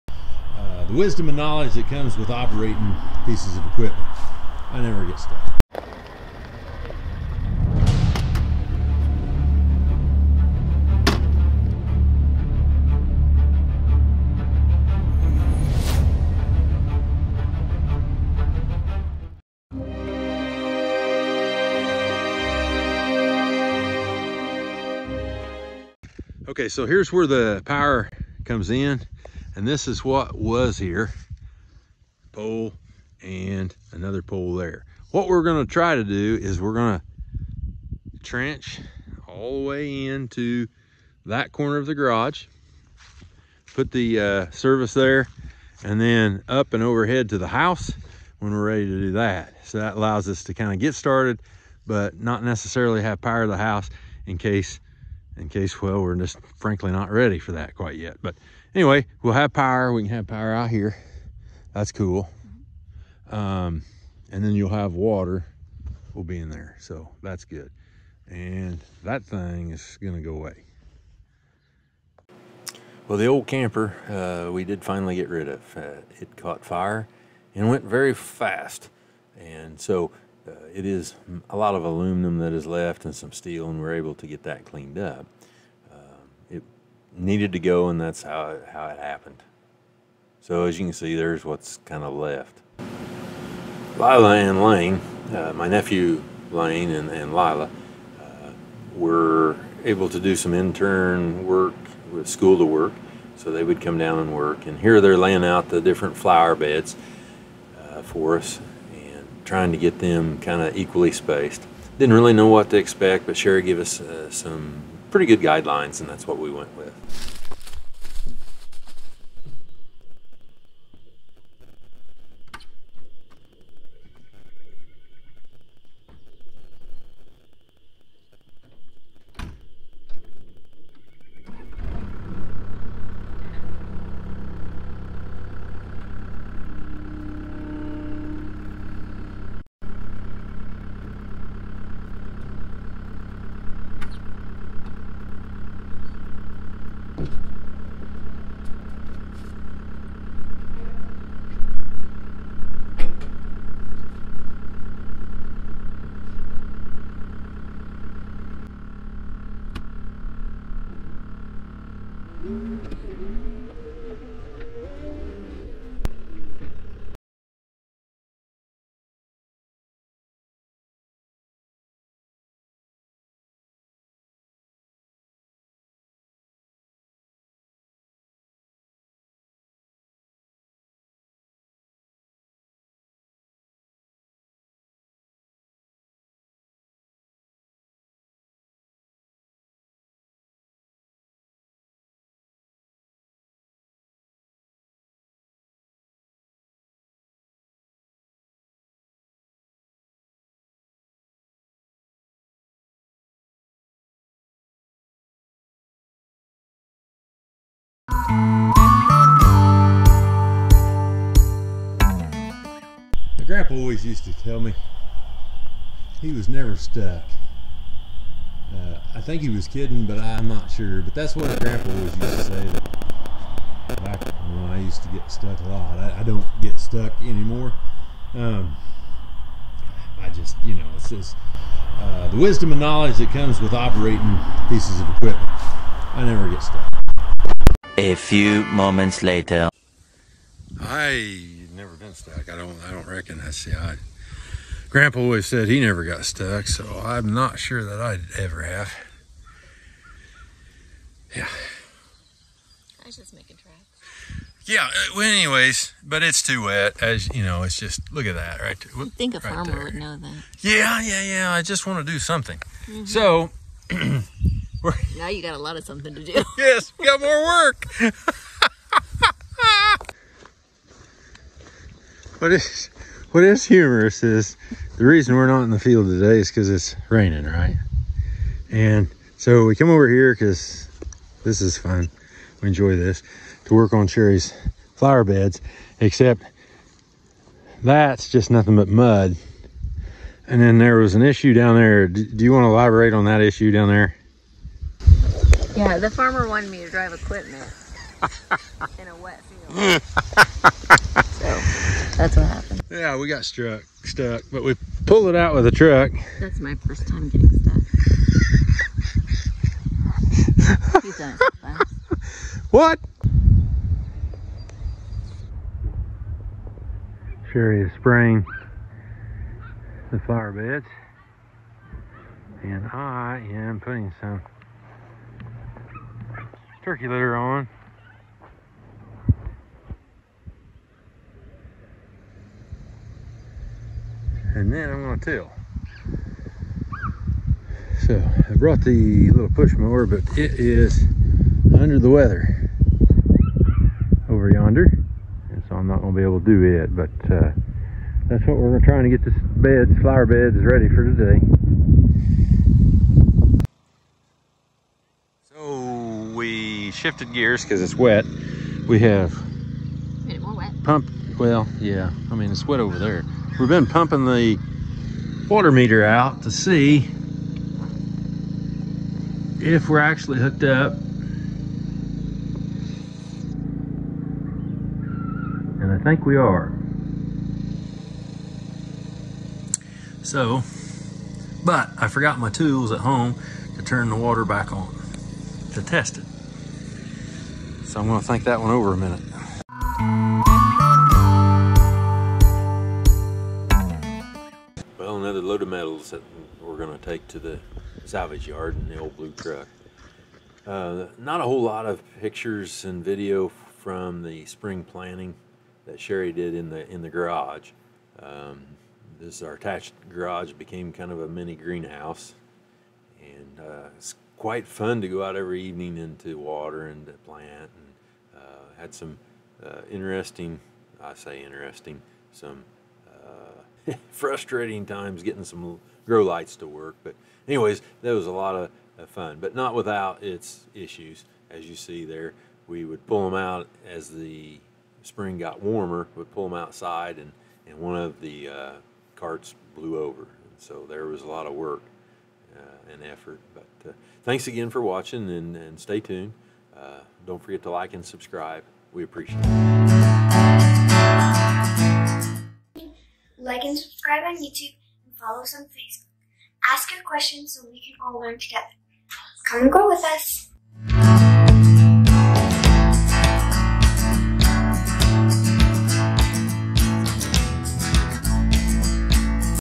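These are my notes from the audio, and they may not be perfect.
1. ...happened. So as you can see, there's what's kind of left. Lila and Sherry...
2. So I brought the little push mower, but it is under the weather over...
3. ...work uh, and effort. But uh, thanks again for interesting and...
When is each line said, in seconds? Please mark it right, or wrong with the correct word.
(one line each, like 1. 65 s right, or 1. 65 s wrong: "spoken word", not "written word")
1. 88 s wrong: "Lane", not "Sherry"
2. 338 s right
3. 441 s wrong: "watching", not "interesting".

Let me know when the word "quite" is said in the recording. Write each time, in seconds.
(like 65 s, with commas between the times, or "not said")
57 s, 414 s.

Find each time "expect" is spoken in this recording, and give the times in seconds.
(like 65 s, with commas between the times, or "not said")
112 s.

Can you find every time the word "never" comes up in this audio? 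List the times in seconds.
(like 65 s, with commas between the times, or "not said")
4 s, 216 s, 236 s, 245 s.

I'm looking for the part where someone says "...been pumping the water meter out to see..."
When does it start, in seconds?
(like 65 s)
363 s.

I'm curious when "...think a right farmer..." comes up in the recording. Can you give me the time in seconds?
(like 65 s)
259 s.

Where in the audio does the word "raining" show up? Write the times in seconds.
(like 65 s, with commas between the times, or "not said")
277 s.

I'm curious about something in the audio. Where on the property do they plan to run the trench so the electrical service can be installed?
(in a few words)
Corner of the garage.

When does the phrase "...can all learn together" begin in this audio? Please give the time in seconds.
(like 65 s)
457 s.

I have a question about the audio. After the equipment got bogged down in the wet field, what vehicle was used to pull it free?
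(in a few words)
A truck.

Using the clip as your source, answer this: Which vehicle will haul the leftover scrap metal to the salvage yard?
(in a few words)
The old blue truck.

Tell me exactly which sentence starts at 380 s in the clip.
So, but I forgot my tools at home to turn the water back on to test it.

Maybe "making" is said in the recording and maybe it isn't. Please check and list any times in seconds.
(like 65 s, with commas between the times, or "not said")
253 s.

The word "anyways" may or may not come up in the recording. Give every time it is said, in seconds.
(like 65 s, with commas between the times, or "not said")
58 s, 255 s, 427 s.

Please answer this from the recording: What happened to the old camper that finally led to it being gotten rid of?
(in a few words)
It caught fire.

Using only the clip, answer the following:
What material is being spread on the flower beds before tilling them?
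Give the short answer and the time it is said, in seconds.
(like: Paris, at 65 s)
Turkey litter, at 326 s.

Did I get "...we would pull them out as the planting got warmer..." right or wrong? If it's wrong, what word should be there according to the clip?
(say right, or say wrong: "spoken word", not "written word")
wrong: "spring", not "planting".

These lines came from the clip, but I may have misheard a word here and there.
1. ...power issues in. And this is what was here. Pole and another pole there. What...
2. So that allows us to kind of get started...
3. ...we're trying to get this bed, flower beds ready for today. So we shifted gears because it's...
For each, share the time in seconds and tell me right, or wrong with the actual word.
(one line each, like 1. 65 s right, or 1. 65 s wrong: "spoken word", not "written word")
1. 27 s wrong: "comes", not "issues"
2. 49 s right
3. 348 s right.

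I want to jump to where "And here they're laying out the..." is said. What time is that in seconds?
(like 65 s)
104 s.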